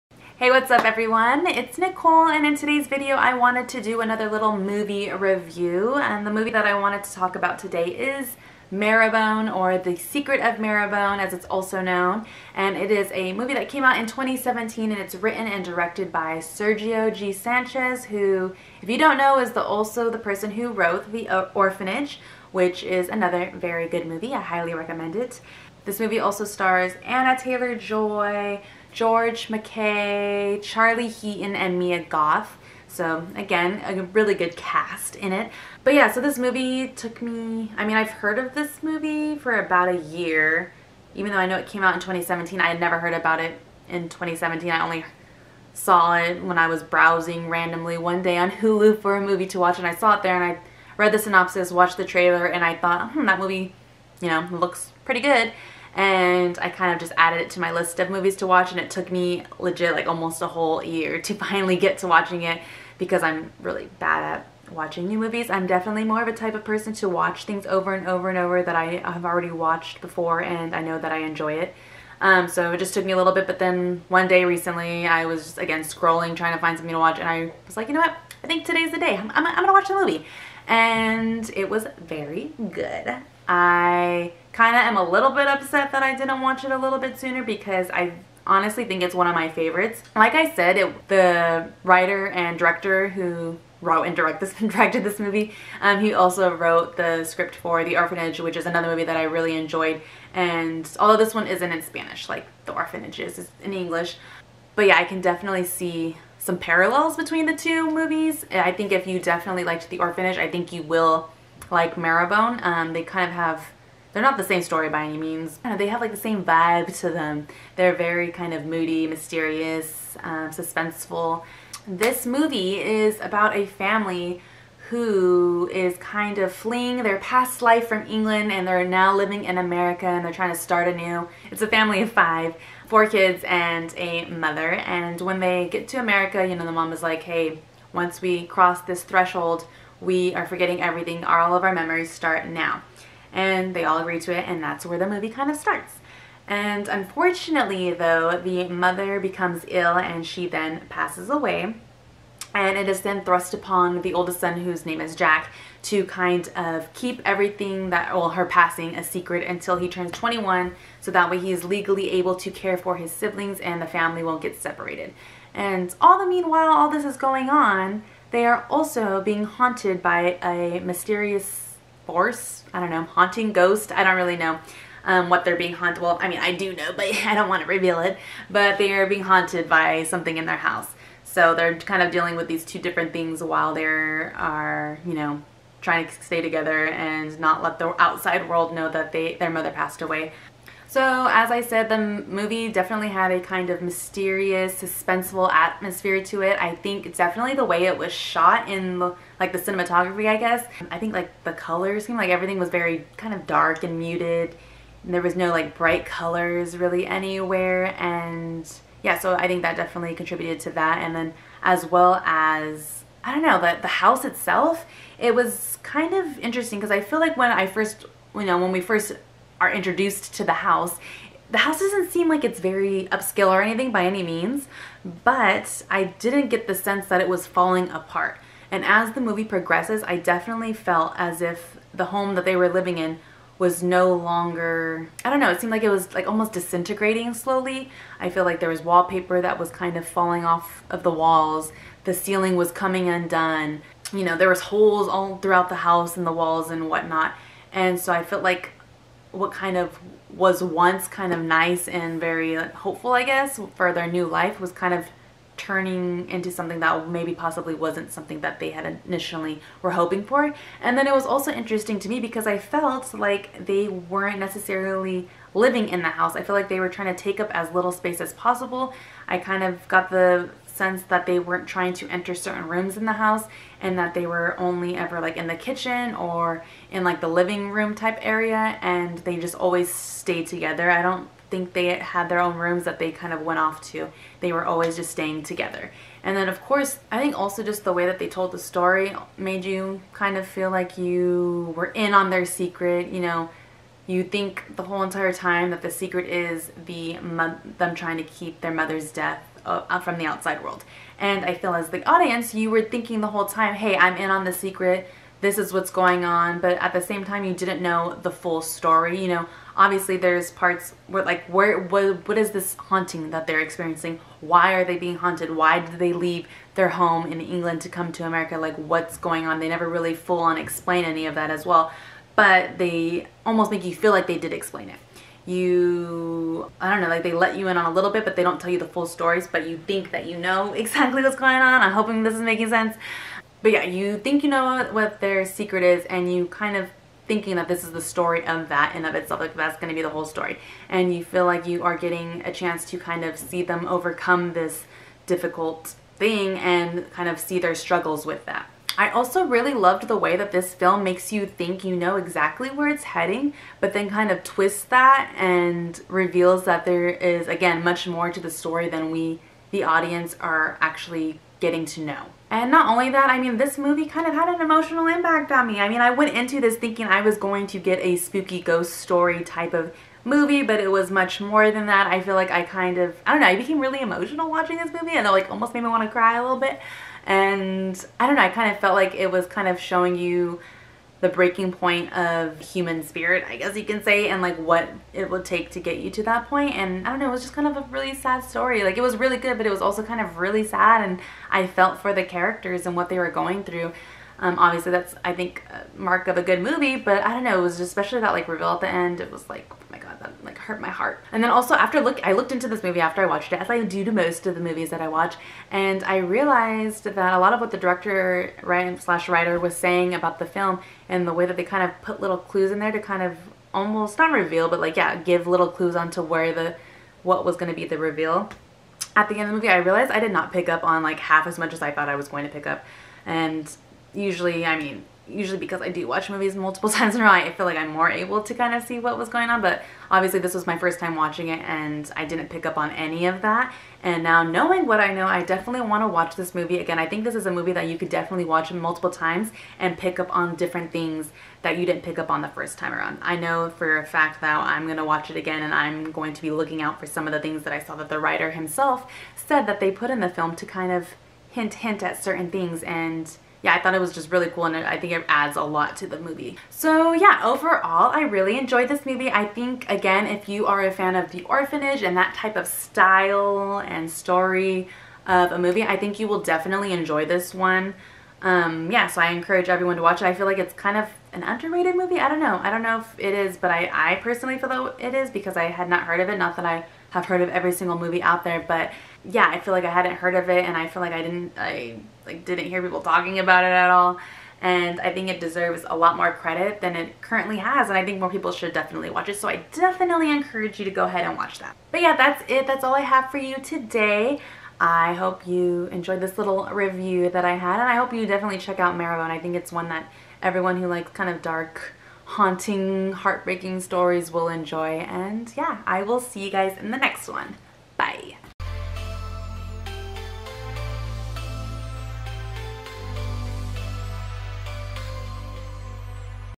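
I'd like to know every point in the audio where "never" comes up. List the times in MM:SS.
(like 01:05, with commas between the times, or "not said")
00:42, 05:19.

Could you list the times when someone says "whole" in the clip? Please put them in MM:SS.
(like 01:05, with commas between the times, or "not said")
01:00, 04:54, 05:03, 05:40.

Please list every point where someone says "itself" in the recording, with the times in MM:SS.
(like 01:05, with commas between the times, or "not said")
03:34, 05:39.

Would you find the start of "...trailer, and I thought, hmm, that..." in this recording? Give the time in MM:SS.
00:52.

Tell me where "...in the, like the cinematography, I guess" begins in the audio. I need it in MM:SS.
03:18.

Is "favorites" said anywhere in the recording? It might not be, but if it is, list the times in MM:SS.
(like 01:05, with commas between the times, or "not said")
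01:29.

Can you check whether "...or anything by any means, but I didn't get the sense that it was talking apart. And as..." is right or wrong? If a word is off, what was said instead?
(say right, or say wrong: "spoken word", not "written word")
wrong: "falling", not "talking".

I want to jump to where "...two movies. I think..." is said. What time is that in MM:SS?
01:47.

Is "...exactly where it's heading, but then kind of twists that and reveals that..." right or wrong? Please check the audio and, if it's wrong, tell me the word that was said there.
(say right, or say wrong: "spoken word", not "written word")
right.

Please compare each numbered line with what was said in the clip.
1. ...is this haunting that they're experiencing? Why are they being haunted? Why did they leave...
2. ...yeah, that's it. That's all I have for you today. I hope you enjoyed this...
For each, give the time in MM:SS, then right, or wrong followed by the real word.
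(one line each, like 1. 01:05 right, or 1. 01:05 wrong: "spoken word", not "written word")
1. 05:12 right
2. 08:12 right.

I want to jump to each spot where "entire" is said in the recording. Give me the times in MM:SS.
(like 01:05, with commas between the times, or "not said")
04:55.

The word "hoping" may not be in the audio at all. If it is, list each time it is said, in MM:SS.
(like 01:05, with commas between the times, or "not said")
04:19, 05:31.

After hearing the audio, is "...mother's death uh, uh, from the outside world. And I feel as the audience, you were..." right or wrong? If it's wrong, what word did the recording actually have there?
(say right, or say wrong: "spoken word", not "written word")
right.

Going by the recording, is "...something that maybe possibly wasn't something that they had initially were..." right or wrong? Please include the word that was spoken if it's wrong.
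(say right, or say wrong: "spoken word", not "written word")
right.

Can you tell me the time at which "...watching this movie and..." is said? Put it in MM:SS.
06:14.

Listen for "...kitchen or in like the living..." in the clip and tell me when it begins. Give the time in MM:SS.
04:35.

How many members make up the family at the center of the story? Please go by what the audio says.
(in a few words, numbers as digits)
5.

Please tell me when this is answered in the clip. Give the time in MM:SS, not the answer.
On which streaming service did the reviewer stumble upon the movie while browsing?
00:48.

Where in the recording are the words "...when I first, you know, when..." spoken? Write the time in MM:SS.
03:37.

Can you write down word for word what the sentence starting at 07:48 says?
Um, yeah, so I encourage everyone to watch it.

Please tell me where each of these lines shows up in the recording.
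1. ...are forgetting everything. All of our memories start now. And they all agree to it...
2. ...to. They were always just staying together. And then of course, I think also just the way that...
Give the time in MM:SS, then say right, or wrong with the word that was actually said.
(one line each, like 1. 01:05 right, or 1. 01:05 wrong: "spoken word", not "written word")
1. 02:20 right
2. 04:43 right.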